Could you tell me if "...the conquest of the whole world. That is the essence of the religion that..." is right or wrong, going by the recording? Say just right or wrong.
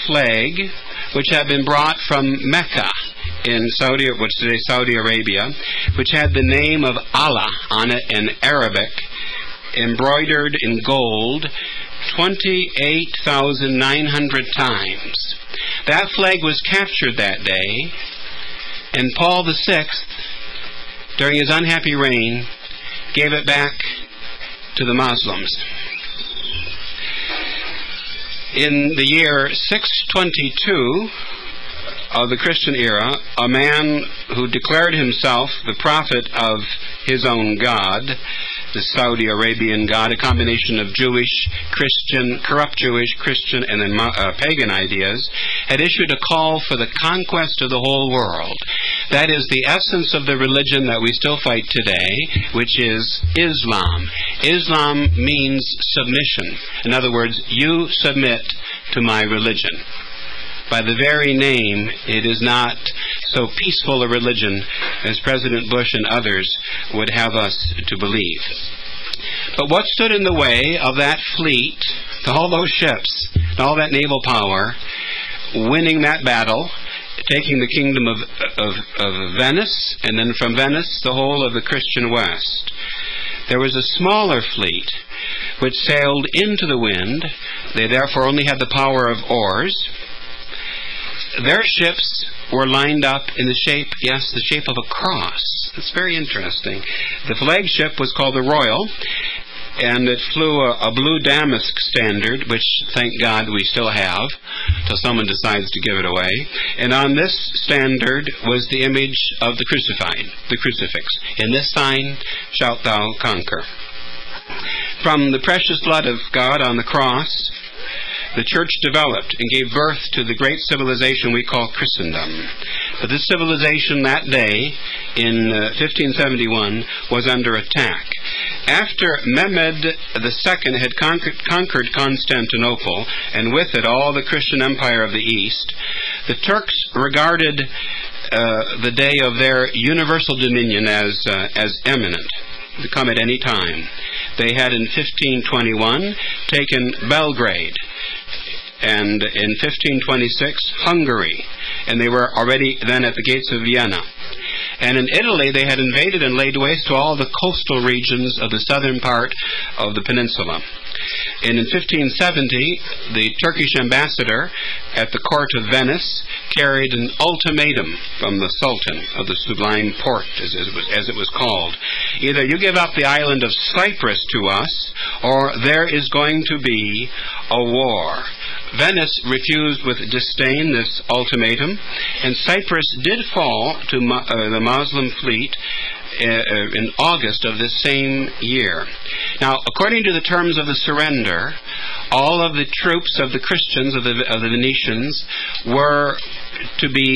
right.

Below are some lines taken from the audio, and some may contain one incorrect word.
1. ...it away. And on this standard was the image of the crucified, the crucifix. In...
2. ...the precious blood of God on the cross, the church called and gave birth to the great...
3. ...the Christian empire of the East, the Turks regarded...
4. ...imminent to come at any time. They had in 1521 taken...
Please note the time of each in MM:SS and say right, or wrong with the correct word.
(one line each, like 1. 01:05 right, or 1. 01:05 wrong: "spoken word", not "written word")
1. 01:45 right
2. 01:55 wrong: "developed", not "called"
3. 02:14 right
4. 02:21 right.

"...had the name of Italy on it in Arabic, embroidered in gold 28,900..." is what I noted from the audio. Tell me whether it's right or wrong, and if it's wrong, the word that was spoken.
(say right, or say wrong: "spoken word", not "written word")
wrong: "Allah", not "Italy".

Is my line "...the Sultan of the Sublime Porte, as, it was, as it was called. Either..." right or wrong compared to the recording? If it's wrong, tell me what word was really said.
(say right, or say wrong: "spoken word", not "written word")
right.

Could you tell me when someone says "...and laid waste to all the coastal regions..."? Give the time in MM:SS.
02:36.